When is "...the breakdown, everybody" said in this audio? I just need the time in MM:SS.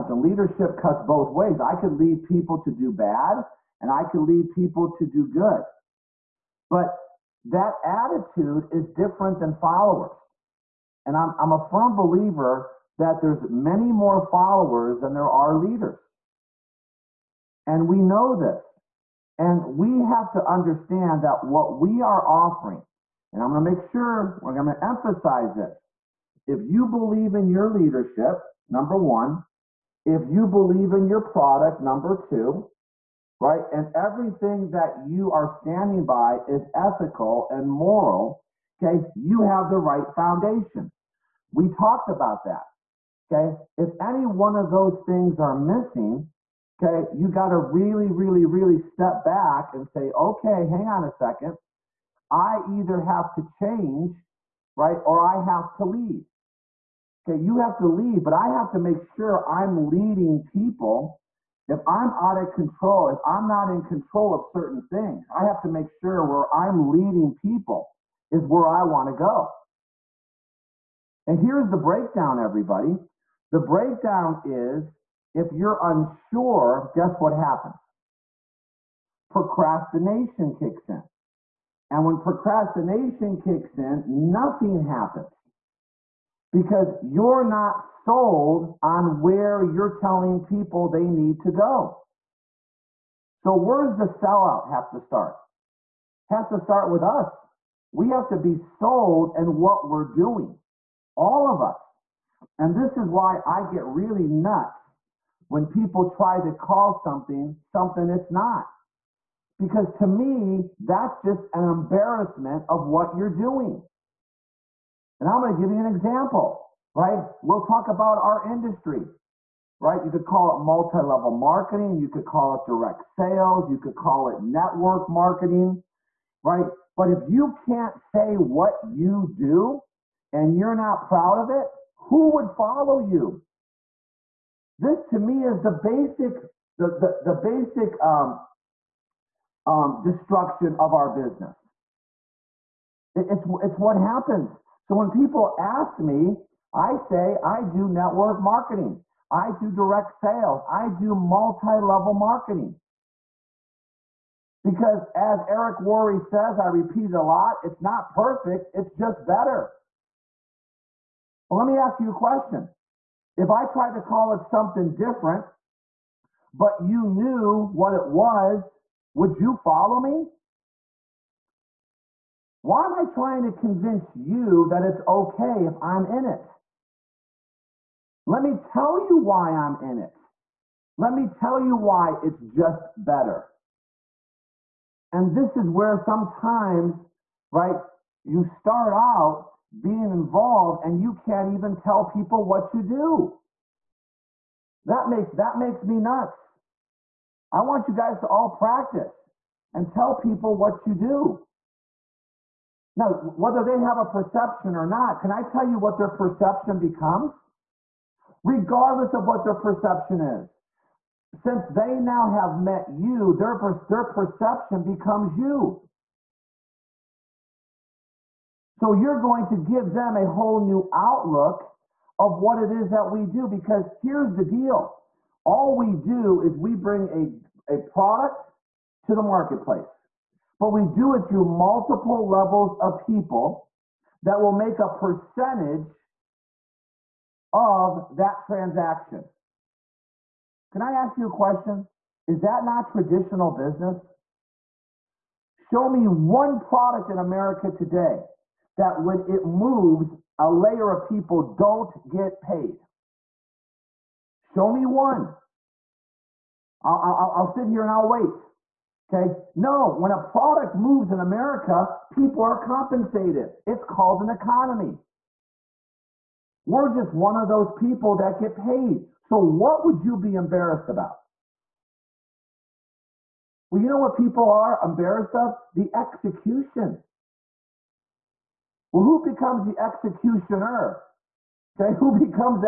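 01:11.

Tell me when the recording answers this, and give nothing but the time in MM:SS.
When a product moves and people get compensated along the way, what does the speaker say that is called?
04:23.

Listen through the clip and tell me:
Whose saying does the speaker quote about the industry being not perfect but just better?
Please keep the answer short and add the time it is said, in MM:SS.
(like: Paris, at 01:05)
Eric Worre, at 02:35.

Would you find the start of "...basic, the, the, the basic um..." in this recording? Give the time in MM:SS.
02:15.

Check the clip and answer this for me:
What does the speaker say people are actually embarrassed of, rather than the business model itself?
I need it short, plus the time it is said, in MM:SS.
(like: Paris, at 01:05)
The execution, at 04:35.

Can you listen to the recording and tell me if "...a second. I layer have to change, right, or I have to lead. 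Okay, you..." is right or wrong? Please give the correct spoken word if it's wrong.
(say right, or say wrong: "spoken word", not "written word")
wrong: "either", not "layer".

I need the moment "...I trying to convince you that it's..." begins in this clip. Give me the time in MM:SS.
02:52.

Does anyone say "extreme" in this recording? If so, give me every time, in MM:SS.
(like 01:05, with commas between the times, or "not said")
not said.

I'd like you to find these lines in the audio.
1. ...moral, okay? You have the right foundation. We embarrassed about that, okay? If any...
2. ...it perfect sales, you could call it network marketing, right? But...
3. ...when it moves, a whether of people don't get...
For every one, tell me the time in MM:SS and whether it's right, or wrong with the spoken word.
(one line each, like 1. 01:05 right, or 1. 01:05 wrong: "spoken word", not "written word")
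1. 00:37 wrong: "talked", not "embarrassed"
2. 02:02 wrong: "direct", not "perfect"
3. 04:09 wrong: "layer", not "whether".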